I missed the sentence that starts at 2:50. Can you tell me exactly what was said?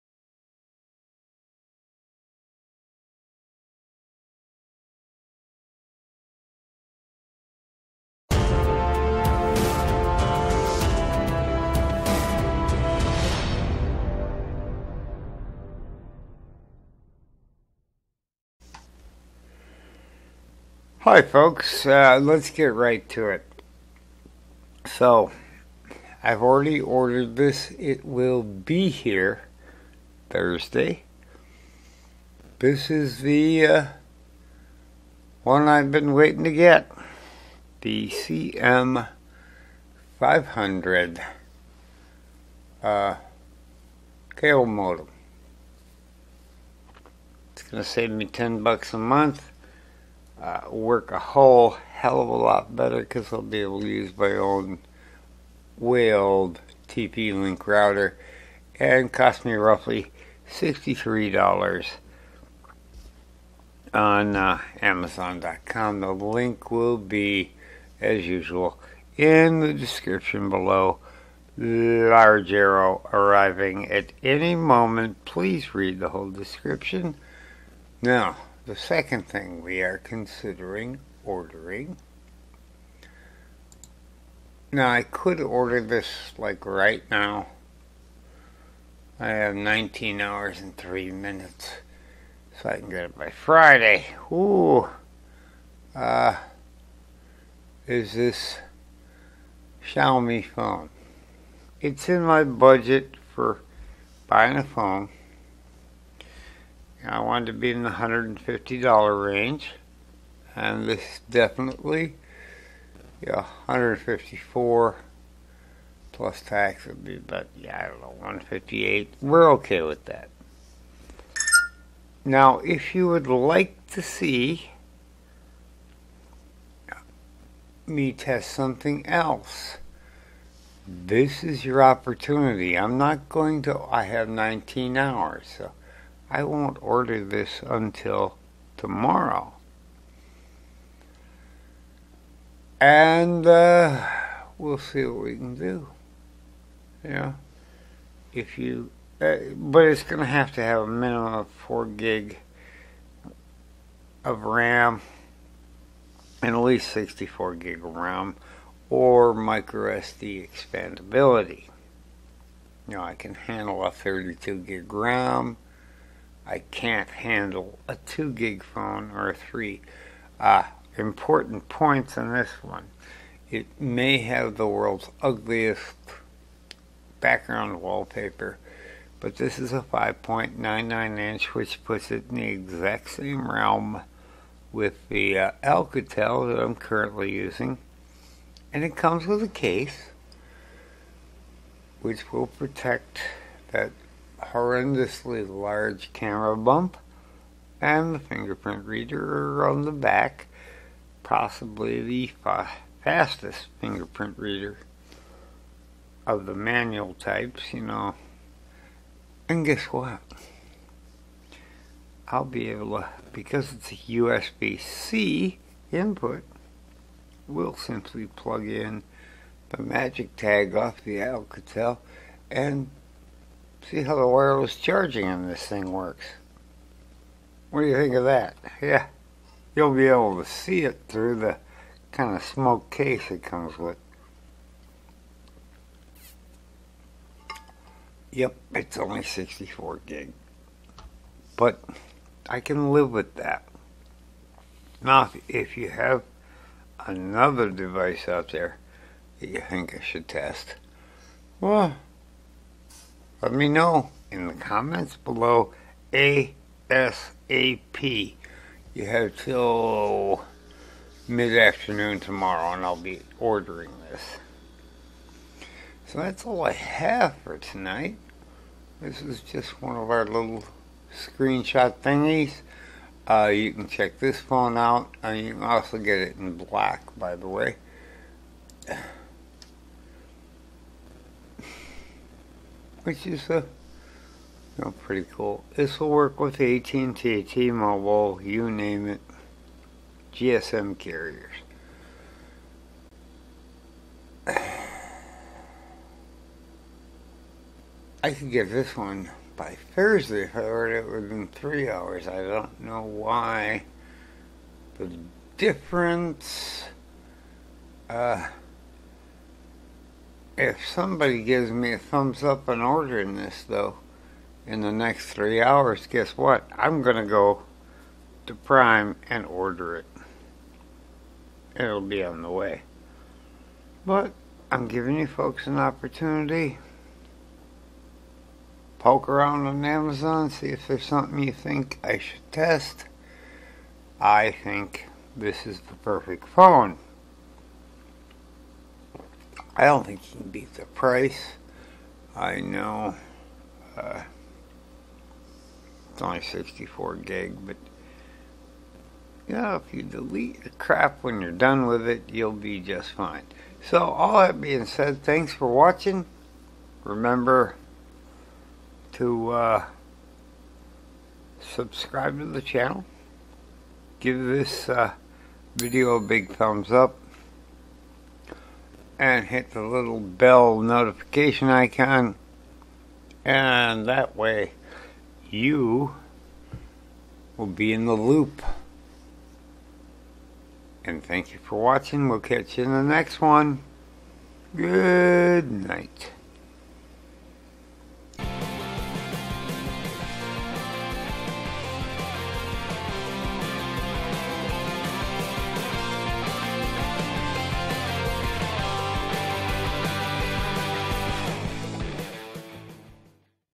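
Uh, important points on this one.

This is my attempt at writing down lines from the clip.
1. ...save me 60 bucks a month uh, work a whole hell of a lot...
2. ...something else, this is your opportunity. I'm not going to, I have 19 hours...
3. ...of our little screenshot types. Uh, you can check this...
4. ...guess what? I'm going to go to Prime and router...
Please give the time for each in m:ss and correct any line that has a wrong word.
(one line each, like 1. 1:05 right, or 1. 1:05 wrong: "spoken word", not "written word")
1. 0:47 wrong: "10", not "60"
2. 2:08 right
3. 4:29 wrong: "thingies", not "types"
4. 5:16 wrong: "order", not "router".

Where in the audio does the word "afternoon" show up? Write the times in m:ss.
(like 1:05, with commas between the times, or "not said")
4:21.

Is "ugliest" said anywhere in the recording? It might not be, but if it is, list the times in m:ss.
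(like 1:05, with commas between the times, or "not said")
2:55.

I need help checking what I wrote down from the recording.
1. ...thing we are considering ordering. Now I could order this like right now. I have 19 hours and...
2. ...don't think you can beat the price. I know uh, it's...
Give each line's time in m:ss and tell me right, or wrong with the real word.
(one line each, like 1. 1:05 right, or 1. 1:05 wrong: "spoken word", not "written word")
1. 1:19 right
2. 5:39 right.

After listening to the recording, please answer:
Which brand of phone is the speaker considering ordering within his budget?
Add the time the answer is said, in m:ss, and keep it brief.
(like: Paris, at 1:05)
Xiaomi, at 1:39.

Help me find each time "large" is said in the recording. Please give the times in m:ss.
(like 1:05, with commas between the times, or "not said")
1:11, 3:15.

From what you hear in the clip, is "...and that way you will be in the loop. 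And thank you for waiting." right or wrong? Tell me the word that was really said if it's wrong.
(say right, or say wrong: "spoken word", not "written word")
wrong: "watching", not "waiting".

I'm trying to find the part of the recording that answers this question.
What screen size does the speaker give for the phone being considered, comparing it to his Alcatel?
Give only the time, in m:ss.
2:59.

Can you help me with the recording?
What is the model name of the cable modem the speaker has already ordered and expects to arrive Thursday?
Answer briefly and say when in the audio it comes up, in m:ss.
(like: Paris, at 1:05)
CM500, at 0:38.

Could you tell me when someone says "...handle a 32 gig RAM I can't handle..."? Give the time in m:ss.
2:43.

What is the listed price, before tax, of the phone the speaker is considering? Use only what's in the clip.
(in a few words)
154.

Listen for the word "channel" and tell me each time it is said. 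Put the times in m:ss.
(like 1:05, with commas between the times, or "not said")
6:02.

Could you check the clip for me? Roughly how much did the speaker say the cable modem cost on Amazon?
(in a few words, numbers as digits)
$63.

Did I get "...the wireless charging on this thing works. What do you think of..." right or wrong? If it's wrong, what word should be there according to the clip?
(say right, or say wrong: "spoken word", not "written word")
right.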